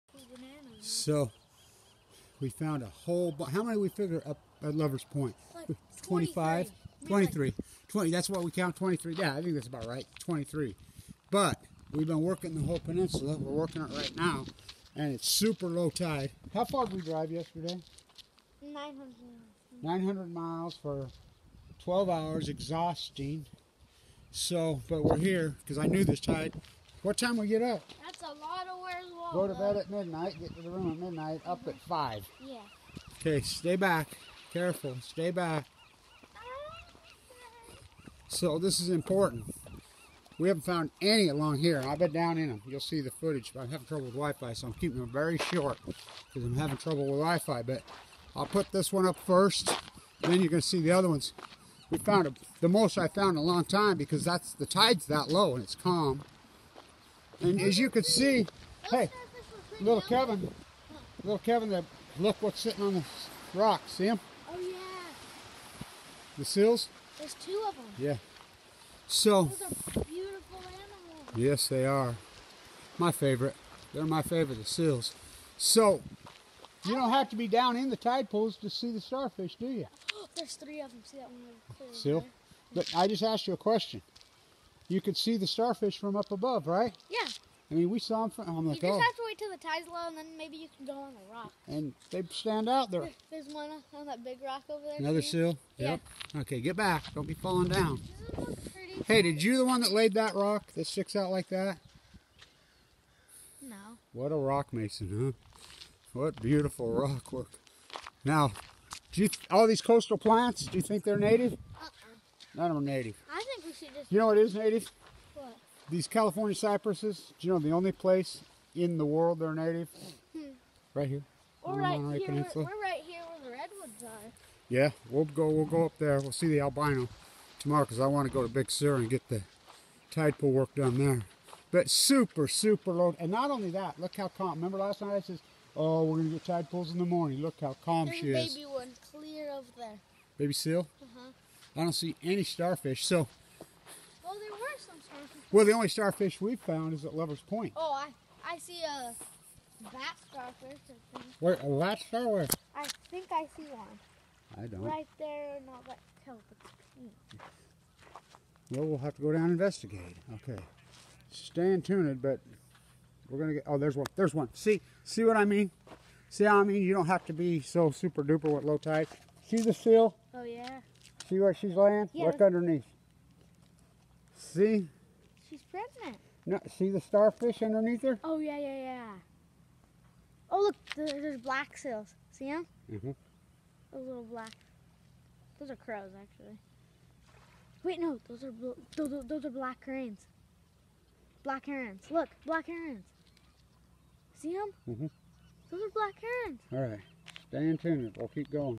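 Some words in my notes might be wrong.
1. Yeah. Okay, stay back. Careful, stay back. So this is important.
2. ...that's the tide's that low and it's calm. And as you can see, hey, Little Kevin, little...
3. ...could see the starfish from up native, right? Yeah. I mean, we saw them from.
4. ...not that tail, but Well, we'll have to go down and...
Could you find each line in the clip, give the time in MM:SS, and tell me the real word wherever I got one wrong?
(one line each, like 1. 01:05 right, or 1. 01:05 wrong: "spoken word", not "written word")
1. 00:32 right
2. 00:54 right
3. 01:25 wrong: "above", not "native"
4. 02:35 right.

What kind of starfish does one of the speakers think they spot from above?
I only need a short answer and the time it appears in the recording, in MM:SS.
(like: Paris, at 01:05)
bat starfish, at 02:29.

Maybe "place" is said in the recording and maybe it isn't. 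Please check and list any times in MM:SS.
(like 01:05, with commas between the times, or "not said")
01:57.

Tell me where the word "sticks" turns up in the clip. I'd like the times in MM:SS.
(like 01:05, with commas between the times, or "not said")
01:40.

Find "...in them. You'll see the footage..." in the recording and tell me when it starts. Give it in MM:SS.
00:42.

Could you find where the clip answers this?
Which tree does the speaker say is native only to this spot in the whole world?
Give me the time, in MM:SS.
01:56.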